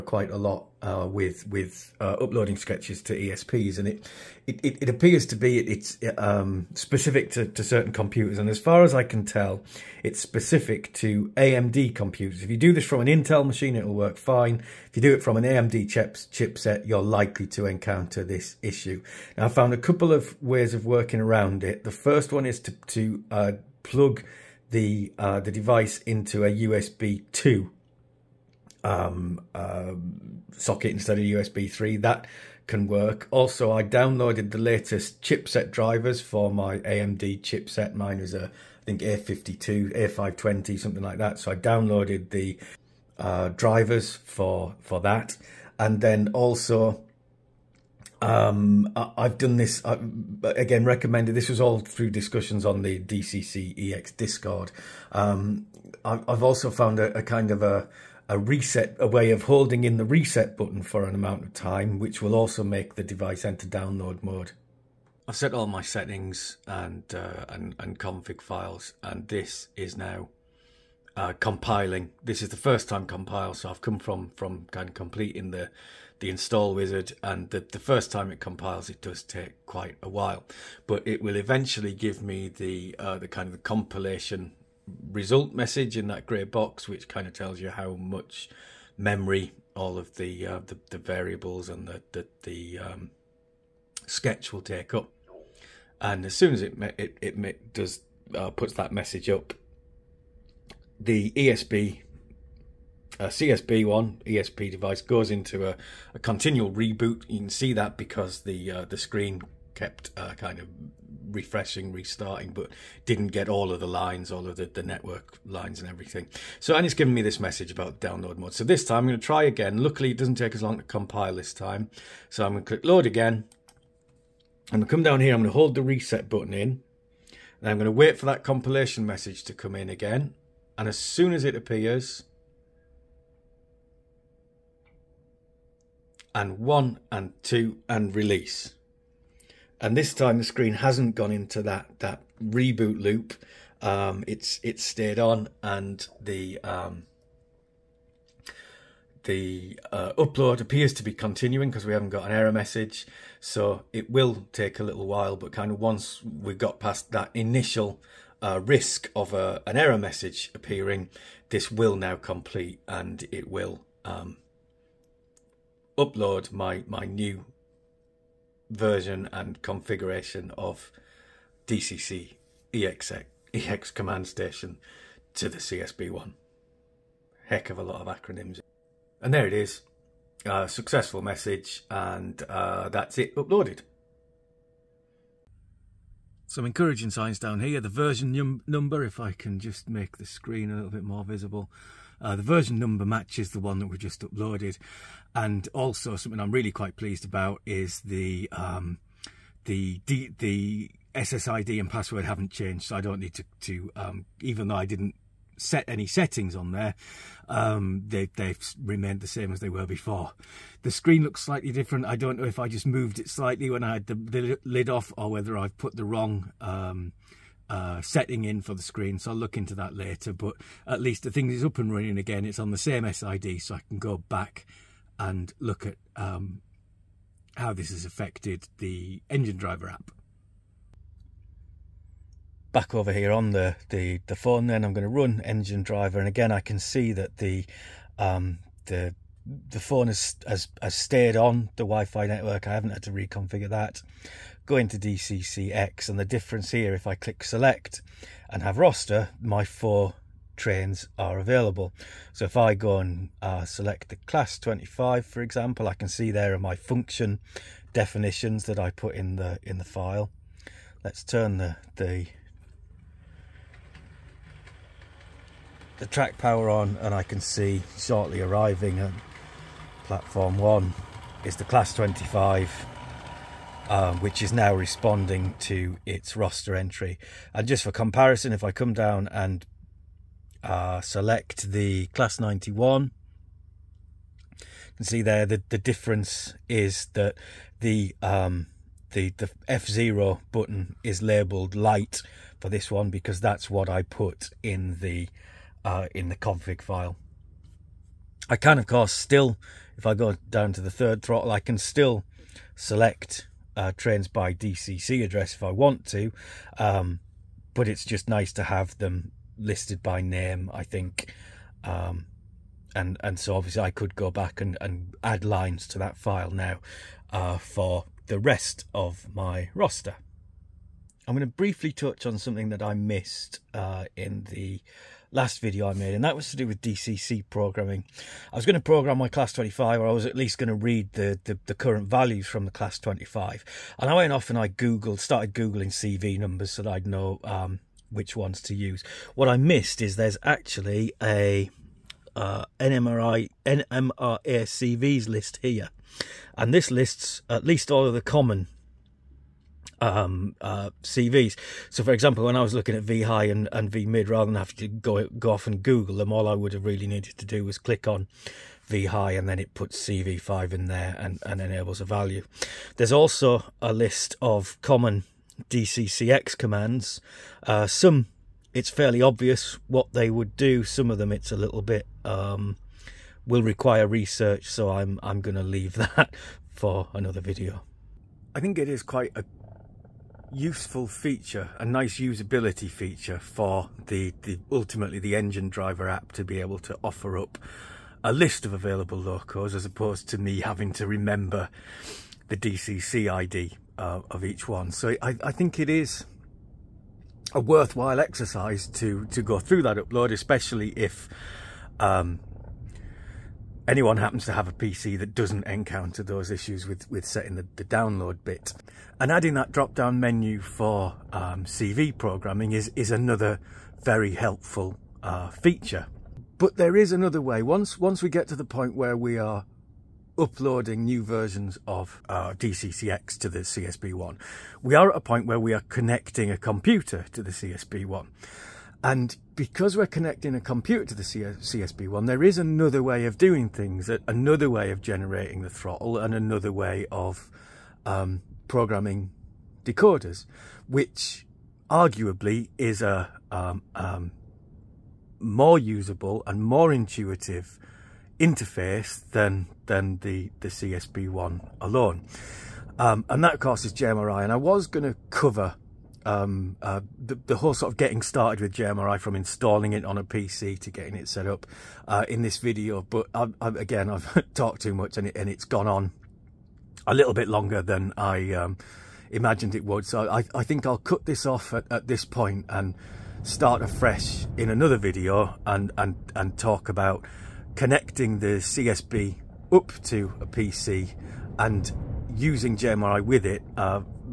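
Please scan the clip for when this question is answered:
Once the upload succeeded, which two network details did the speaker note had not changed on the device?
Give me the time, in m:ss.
3:21.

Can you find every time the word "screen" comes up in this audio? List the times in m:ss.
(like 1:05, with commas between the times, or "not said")
1:48, 2:20, 3:10, 3:30, 3:38.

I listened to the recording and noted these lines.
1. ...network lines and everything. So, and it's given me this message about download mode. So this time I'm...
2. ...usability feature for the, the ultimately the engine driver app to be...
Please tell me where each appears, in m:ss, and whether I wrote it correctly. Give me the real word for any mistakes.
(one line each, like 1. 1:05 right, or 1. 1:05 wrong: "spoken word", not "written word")
1. 1:54 right
2. 6:22 right.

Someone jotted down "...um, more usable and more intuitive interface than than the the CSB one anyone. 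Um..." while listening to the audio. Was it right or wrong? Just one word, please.
wrong.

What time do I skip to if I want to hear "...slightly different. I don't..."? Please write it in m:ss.
3:31.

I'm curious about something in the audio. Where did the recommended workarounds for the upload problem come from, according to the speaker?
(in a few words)
DCC EX Discord.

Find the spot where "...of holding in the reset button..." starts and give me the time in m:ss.
0:59.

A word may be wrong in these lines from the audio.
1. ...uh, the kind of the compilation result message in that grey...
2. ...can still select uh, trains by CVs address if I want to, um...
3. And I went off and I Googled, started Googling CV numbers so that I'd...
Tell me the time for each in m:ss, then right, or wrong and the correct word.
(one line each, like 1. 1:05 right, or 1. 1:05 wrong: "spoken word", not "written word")
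1. 1:22 right
2. 5:01 wrong: "DCC", not "CVs"
3. 5:33 right.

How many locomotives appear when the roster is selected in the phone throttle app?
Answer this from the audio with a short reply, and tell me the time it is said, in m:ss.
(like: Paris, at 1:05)
4, at 4:09.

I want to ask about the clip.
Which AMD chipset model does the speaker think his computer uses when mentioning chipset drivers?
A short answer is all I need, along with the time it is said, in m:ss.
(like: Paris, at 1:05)
A520, at 0:39.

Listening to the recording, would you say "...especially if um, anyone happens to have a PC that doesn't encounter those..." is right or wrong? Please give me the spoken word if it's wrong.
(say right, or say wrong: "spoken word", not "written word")
right.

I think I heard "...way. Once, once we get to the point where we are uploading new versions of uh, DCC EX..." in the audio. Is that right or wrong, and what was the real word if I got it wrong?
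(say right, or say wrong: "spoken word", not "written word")
right.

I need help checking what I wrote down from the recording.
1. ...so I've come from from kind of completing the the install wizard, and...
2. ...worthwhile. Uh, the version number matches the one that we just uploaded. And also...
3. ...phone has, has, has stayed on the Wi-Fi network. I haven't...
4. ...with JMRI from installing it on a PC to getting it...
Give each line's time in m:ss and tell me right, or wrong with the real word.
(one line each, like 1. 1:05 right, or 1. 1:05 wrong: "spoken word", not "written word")
1. 1:13 right
2. 3:11 wrong: "visible", not "worthwhile"
3. 3:59 right
4. 7:38 right.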